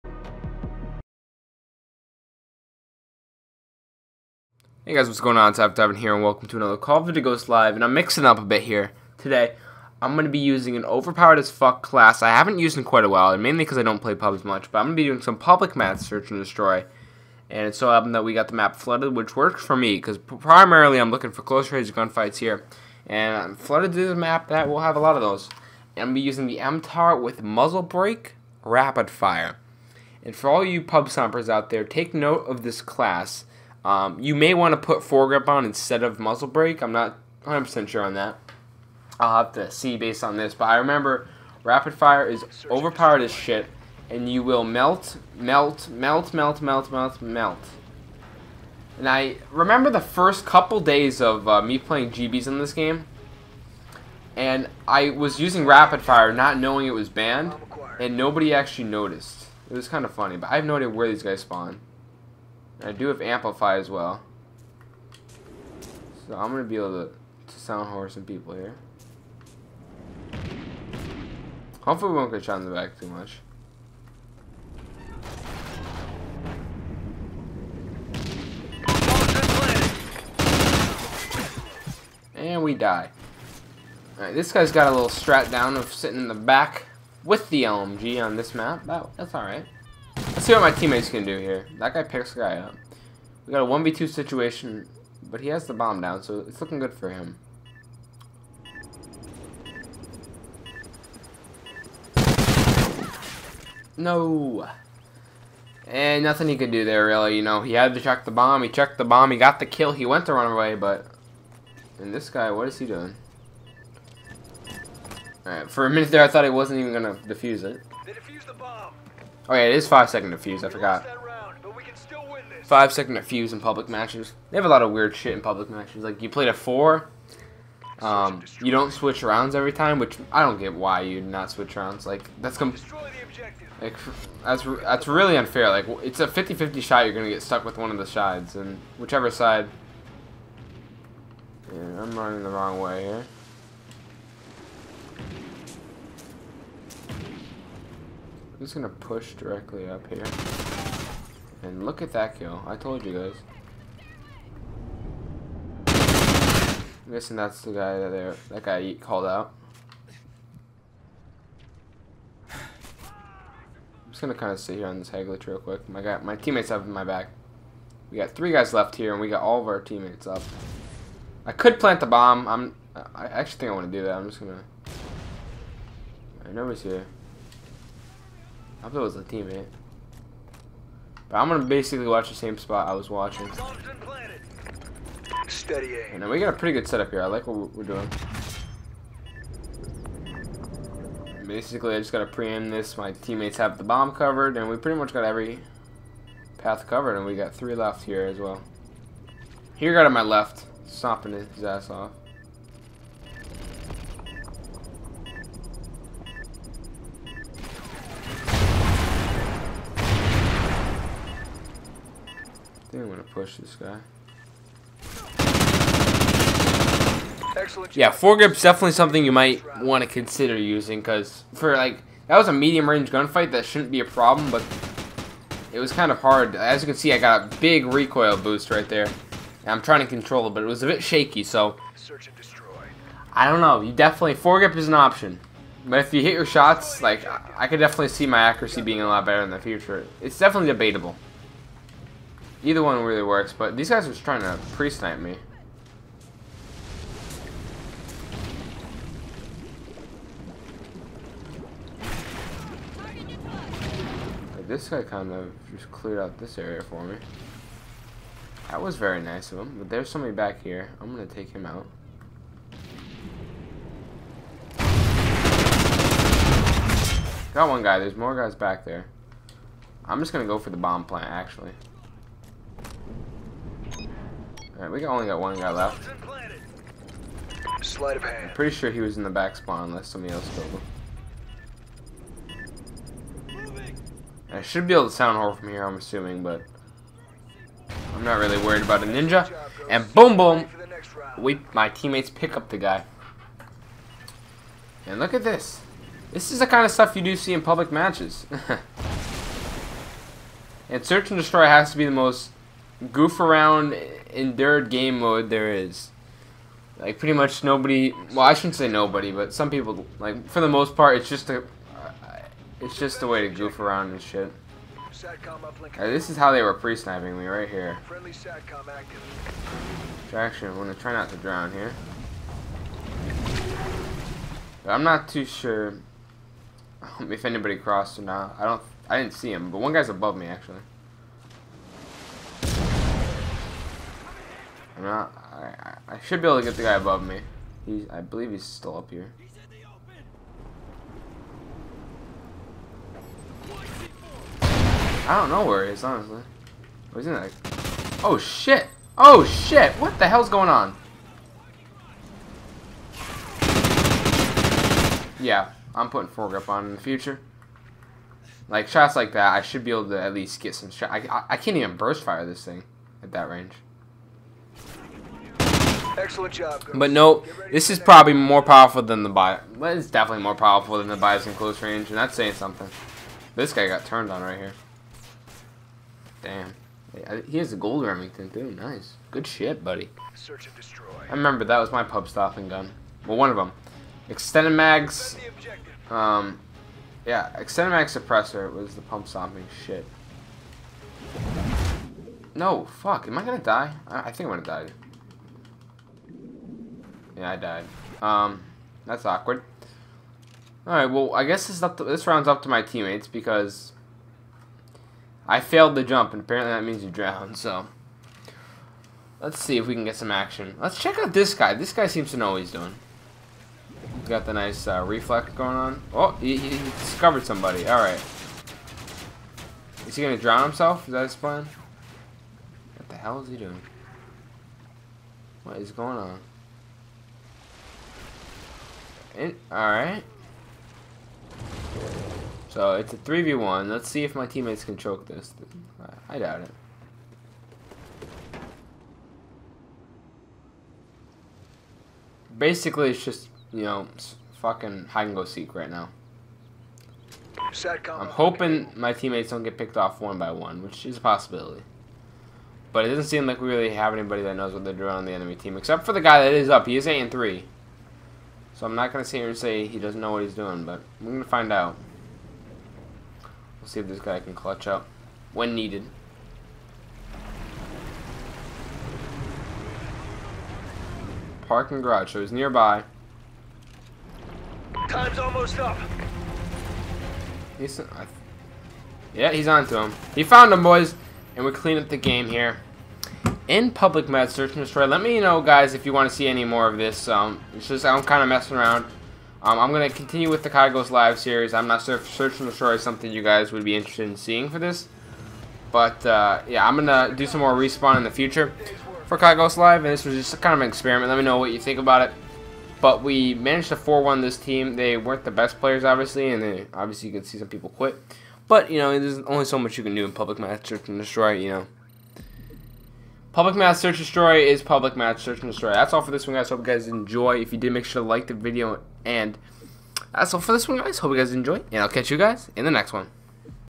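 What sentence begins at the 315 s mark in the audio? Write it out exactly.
Right, this is how they were pre-sniping me right here.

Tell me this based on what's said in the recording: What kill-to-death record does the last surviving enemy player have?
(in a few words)
8 and 3.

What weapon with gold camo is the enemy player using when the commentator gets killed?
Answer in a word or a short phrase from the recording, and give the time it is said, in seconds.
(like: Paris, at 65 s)
Remington, at 377 s.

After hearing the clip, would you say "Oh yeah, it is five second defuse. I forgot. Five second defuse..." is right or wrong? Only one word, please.
right.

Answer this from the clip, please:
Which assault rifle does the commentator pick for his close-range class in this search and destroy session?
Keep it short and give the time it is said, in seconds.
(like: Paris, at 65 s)
MTAR, at 26 s.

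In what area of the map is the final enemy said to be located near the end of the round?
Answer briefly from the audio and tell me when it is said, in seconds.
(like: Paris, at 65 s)
Parking garage, at 471 s.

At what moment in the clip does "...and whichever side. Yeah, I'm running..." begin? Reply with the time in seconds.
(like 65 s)
138 s.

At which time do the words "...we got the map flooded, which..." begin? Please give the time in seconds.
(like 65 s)
18 s.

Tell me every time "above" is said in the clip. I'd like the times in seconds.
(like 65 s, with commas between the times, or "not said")
330 s, 336 s.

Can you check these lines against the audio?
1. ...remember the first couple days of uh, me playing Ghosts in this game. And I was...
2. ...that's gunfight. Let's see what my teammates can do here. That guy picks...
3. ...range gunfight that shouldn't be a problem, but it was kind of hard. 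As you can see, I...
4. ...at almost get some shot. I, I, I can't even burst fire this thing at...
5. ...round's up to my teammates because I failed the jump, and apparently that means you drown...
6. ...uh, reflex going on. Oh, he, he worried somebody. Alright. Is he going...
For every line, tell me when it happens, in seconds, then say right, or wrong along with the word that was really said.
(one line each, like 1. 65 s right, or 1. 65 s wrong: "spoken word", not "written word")
1. 49 s wrong: "GBs", not "Ghosts"
2. 89 s wrong: "alright", not "gunfight"
3. 222 s right
4. 360 s wrong: "least", not "almost"
5. 402 s right
6. 414 s wrong: "discovered", not "worried".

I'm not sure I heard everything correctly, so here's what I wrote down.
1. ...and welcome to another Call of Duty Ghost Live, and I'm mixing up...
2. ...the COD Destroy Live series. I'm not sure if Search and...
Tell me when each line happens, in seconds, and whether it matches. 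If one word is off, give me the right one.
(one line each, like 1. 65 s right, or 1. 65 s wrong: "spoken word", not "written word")
1. 6 s right
2. 490 s wrong: "Ghosts", not "Destroy".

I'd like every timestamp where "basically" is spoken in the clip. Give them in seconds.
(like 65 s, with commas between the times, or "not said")
181 s, 191 s, 442 s.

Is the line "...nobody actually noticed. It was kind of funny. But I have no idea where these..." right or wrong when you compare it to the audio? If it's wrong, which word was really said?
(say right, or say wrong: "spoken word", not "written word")
right.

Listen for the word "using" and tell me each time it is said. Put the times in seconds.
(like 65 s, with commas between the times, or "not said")
10 s, 26 s, 55 s, 220 s.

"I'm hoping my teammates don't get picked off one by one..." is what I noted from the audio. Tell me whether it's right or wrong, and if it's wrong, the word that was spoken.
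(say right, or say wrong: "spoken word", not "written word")
right.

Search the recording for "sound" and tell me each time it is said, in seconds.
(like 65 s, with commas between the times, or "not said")
67 s, 285 s.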